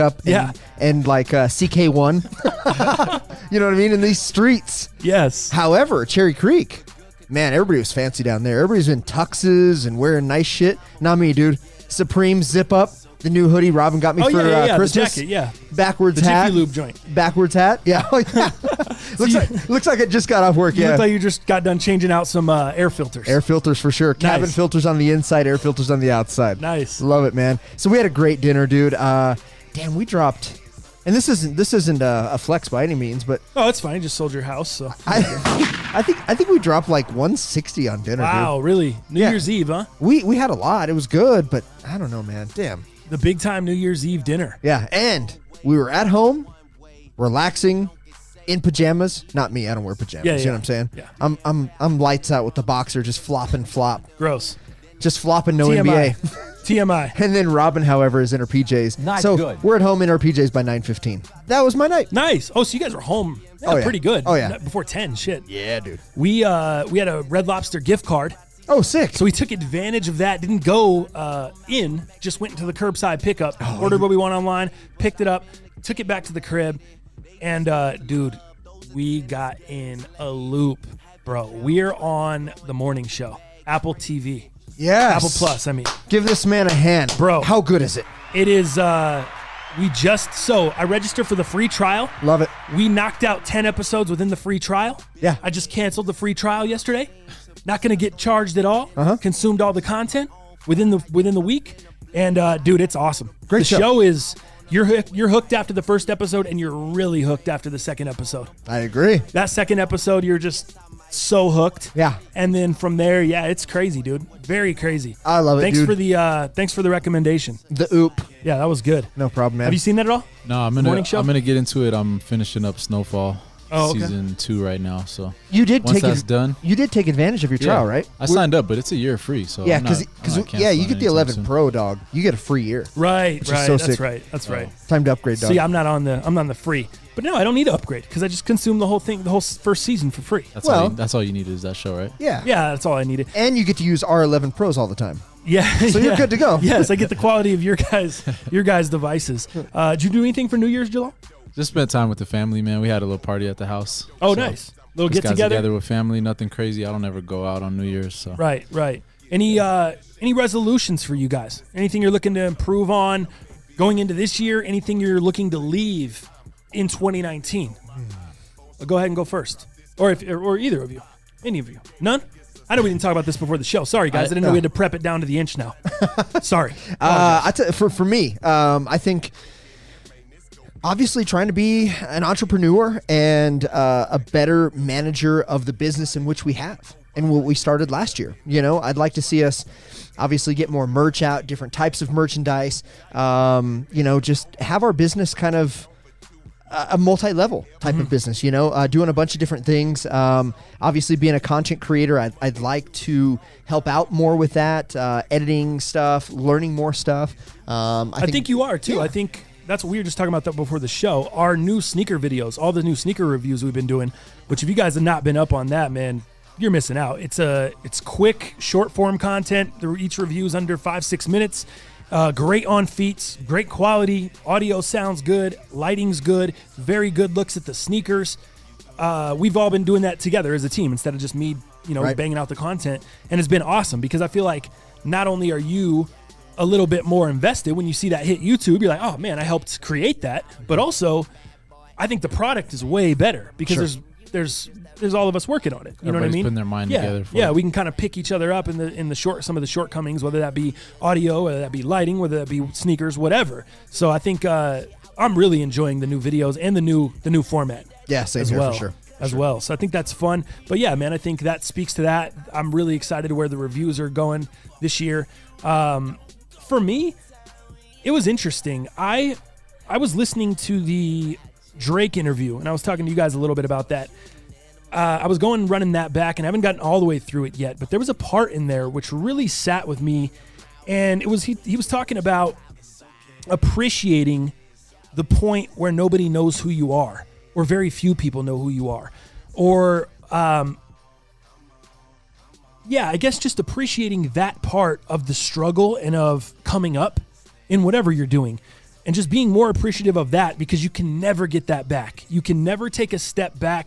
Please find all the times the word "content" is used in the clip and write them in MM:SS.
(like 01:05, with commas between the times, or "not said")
01:39, 03:21, 03:39, 03:52.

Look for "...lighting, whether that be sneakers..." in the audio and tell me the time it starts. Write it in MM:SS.
04:11.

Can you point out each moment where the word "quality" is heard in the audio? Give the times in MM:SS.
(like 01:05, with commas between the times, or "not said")
02:27, 03:43.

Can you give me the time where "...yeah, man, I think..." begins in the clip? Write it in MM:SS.
04:20.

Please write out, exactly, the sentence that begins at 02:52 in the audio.
I know we didn't talk about this before the show.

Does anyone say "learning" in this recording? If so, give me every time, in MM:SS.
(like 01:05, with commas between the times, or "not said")
03:26.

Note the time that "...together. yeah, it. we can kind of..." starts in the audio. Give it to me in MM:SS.
04:07.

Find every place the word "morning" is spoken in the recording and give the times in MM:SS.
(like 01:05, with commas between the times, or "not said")
01:22, 02:00.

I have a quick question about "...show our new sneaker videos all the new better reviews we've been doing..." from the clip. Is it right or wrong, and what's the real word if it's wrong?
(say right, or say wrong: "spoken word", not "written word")
wrong: "sneaker", not "better".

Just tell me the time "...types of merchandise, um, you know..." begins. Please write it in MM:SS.
03:11.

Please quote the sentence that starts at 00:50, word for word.
Yeah, You know what I'm saying?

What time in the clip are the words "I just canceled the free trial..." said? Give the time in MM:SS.
01:35.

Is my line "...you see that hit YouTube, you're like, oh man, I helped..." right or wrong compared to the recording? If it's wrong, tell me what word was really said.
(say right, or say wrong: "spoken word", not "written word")
right.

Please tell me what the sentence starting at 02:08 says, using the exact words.
I We're, signed up, but it's a year free, so yeah, because yeah, you get the 11 soon.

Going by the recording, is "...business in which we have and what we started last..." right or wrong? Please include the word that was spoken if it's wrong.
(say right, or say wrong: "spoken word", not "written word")
right.